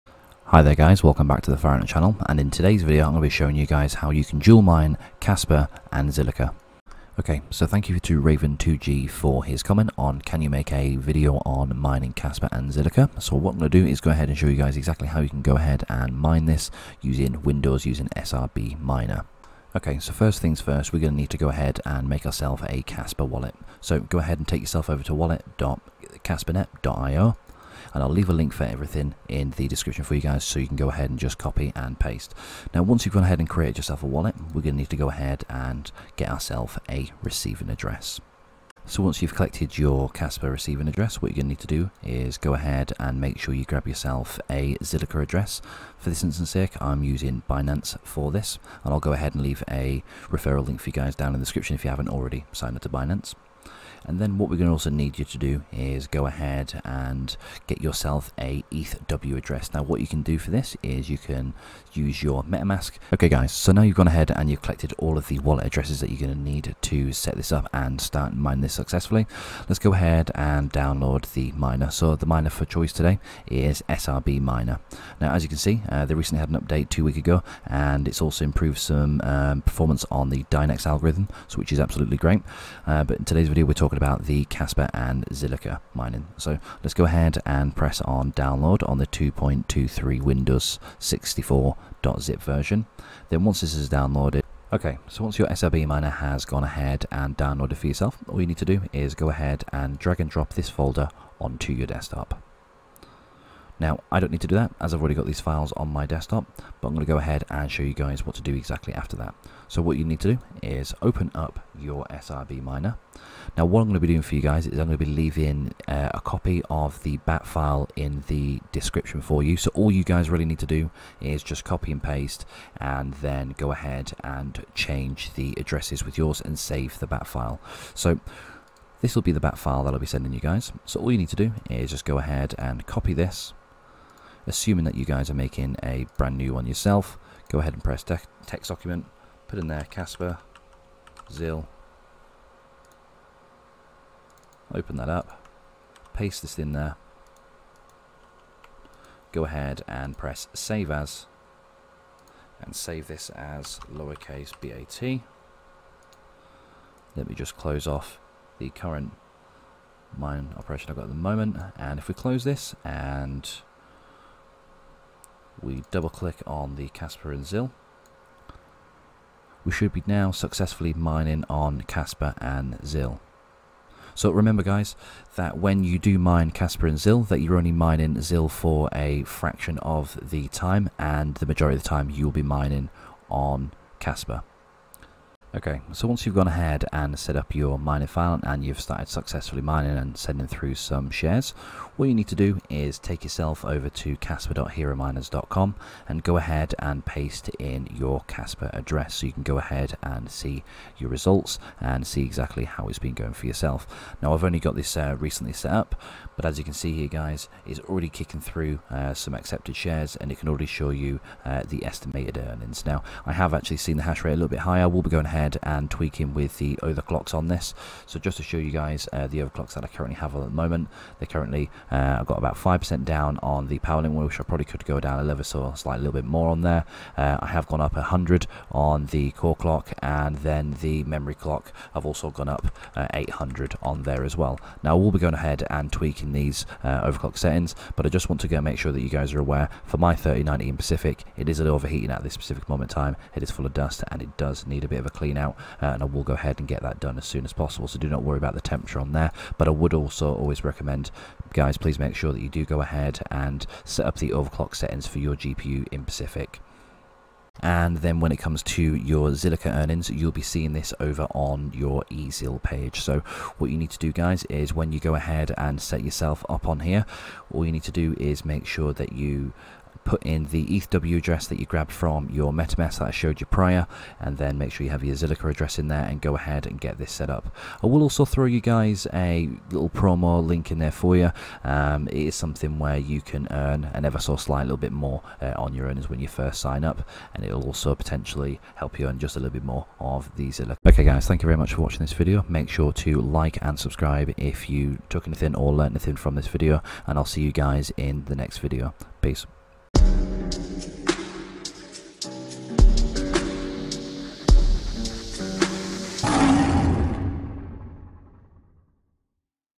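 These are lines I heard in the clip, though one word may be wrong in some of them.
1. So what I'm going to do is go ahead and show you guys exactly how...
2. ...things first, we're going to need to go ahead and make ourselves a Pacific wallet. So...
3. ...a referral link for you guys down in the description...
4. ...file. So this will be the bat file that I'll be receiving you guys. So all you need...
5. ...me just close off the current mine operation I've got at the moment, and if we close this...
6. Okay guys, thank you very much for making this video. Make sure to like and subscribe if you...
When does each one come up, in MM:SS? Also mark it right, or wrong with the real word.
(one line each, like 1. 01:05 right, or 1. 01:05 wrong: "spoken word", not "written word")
1. 00:13 right
2. 00:20 wrong: "Kaspa", not "Pacific"
3. 00:49 right
4. 02:07 wrong: "sending", not "receiving"
5. 02:37 right
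6. 04:50 wrong: "watching", not "making".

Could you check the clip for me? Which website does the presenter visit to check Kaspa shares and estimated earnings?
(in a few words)
kaspa.herominers.com.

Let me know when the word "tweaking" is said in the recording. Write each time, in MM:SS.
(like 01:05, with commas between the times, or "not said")
03:35, 03:55.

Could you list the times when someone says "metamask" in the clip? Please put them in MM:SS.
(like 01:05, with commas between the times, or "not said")
01:02, 04:32.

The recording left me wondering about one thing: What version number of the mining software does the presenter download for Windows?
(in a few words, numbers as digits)
2.23.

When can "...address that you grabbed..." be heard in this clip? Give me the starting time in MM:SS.
04:31.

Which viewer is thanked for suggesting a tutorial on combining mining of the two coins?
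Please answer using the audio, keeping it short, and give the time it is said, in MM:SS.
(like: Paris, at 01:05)
Raven2G, at 00:08.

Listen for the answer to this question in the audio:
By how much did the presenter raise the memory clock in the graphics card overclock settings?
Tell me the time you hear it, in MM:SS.
03:53.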